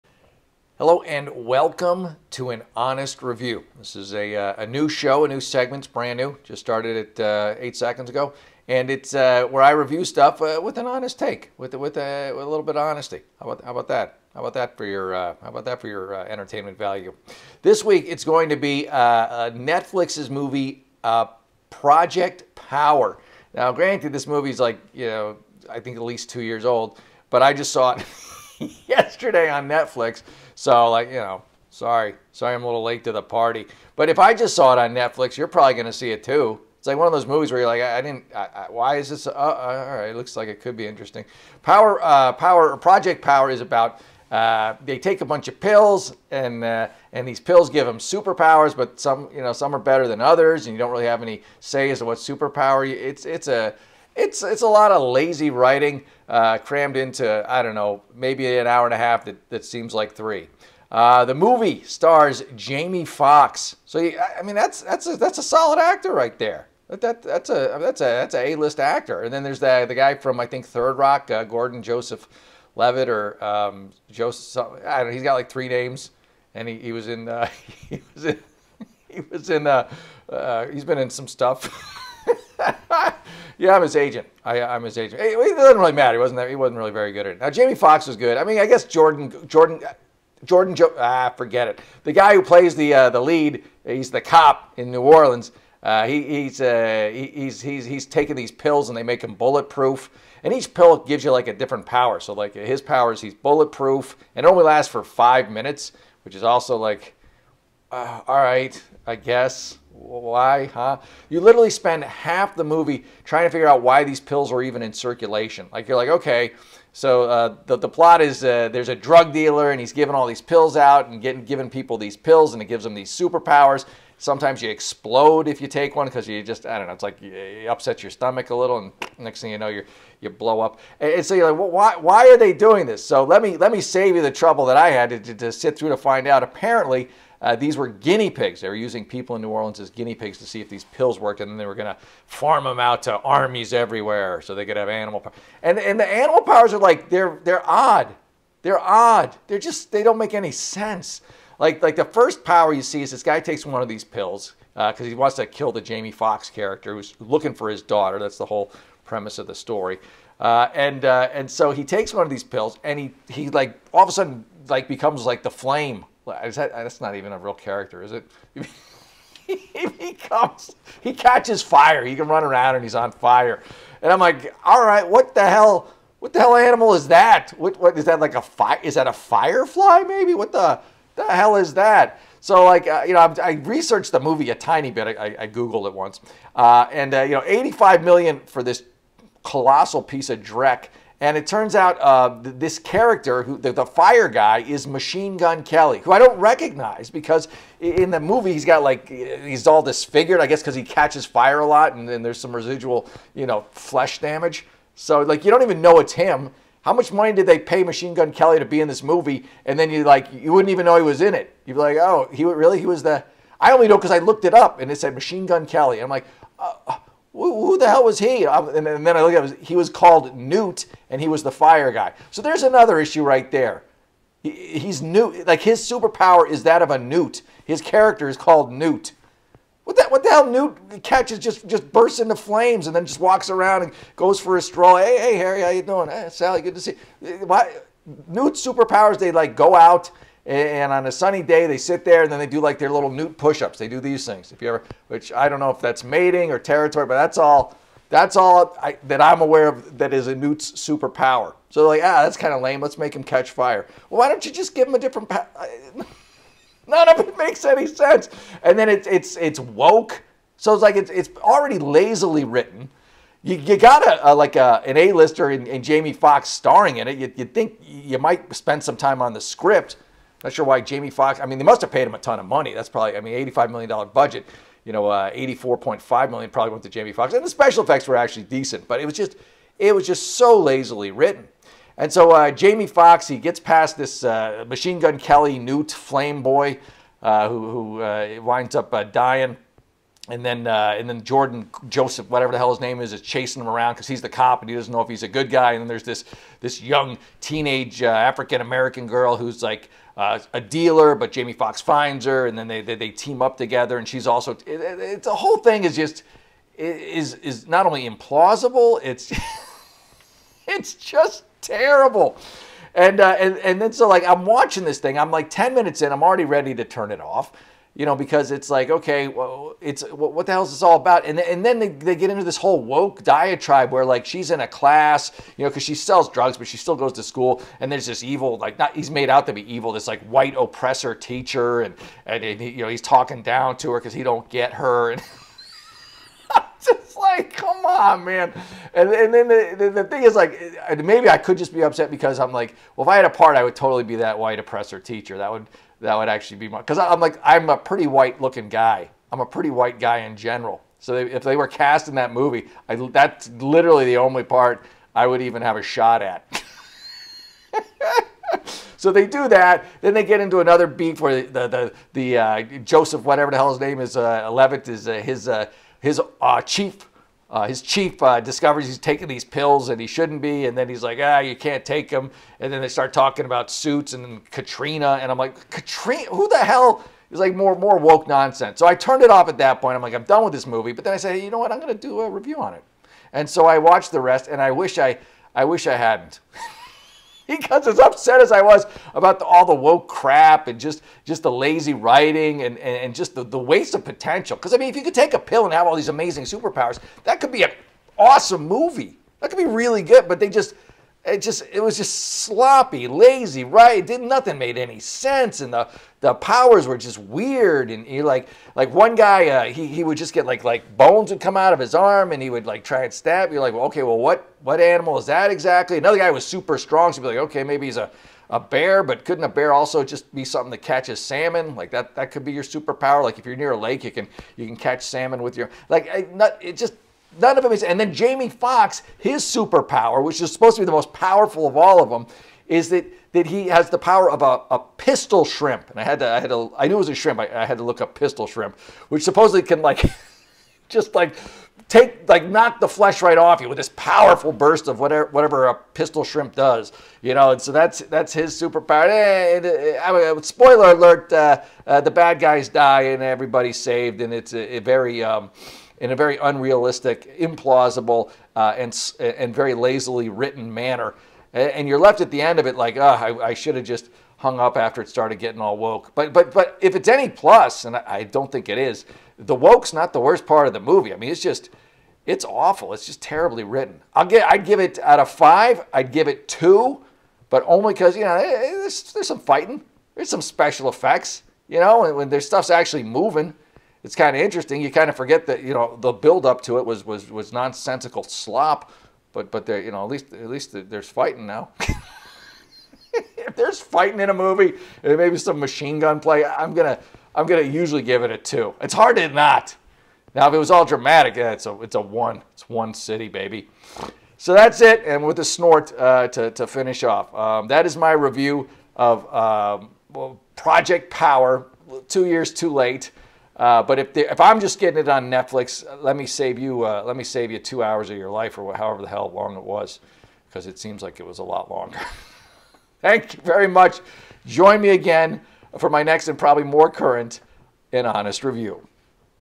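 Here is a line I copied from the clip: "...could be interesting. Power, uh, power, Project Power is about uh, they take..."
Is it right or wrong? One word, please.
right.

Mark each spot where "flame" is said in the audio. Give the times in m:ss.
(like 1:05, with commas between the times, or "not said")
2:45, 3:52, 4:45.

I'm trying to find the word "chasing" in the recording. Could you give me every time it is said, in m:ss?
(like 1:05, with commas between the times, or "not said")
4:53.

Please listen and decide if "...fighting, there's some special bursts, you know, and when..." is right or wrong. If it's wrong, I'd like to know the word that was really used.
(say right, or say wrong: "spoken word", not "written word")
wrong: "effects", not "bursts".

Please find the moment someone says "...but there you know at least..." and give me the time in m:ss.
8:09.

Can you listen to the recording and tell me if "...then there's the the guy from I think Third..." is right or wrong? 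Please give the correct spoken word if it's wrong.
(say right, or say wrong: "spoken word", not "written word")
right.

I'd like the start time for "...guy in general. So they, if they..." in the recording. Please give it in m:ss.
5:49.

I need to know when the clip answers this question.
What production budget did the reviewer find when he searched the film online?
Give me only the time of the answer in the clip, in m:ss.
3:07.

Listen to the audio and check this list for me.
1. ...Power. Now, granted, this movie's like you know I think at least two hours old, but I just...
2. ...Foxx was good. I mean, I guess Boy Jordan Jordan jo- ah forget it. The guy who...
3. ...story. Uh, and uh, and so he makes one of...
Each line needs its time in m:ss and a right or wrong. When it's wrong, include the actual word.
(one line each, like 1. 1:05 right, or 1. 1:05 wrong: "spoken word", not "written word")
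1. 0:22 wrong: "years", not "hours"
2. 1:27 wrong: "Jordan", not "Boy"
3. 2:39 wrong: "takes", not "makes".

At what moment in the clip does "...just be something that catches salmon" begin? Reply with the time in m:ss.
7:00.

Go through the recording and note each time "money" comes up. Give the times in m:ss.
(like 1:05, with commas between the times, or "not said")
3:27, 4:32.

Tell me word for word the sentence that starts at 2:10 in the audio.
And so you're like, well, why, why are they doing this?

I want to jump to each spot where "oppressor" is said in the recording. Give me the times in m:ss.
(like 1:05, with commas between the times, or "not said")
5:30, 5:44.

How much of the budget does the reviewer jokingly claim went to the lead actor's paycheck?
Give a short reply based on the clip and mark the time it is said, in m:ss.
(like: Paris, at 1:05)
$84.5 million, at 4:35.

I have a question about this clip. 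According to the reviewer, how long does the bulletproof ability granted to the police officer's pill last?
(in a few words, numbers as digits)
5 minutes.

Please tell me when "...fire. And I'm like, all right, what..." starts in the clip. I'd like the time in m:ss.
2:53.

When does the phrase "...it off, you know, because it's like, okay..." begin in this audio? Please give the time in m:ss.
5:17.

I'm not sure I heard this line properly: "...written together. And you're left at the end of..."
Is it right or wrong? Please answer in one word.
wrong.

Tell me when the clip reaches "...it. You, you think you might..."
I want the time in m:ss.
4:27.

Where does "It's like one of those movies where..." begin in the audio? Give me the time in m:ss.
0:36.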